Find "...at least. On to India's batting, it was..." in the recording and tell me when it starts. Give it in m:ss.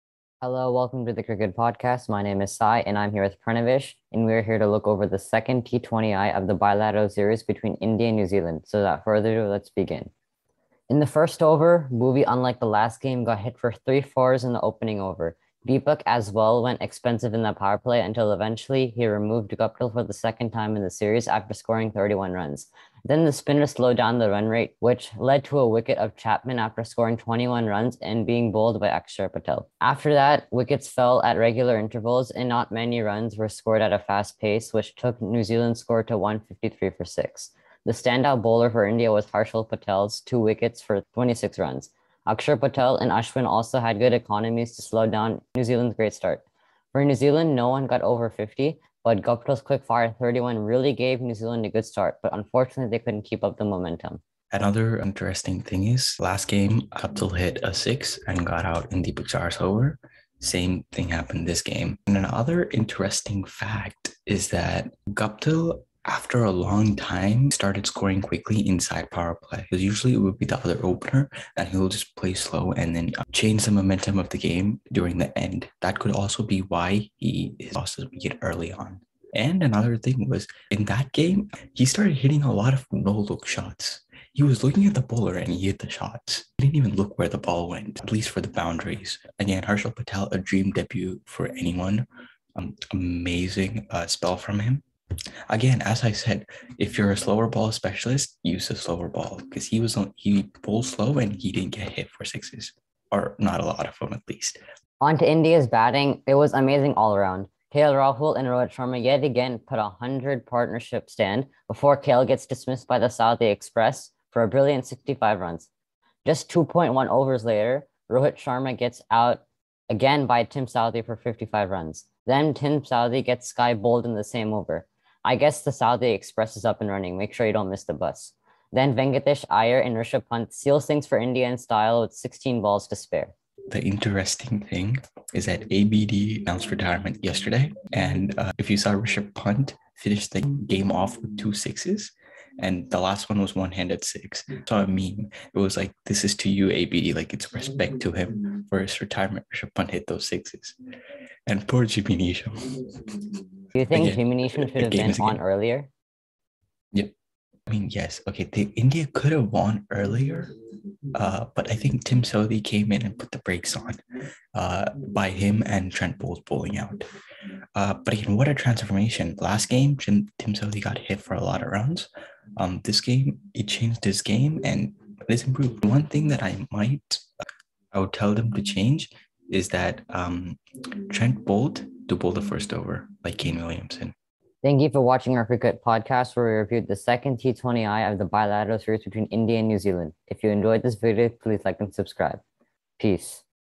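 1:44.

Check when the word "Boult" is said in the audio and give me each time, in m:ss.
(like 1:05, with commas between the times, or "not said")
2:46, 3:01.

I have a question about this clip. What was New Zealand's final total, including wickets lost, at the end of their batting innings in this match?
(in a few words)
153 for 6.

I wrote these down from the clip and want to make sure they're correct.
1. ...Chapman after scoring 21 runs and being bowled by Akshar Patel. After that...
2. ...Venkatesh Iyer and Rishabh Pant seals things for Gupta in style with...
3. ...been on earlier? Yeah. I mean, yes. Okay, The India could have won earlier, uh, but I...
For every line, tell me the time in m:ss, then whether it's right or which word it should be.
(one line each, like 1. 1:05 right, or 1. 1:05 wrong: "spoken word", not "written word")
1. 0:26 right
2. 2:08 wrong: "India", not "Gupta"
3. 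2:34 right.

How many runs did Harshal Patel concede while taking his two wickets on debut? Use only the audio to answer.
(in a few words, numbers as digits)
26.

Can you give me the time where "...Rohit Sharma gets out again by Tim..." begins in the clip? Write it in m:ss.
1:58.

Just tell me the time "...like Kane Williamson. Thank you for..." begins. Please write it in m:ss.
3:03.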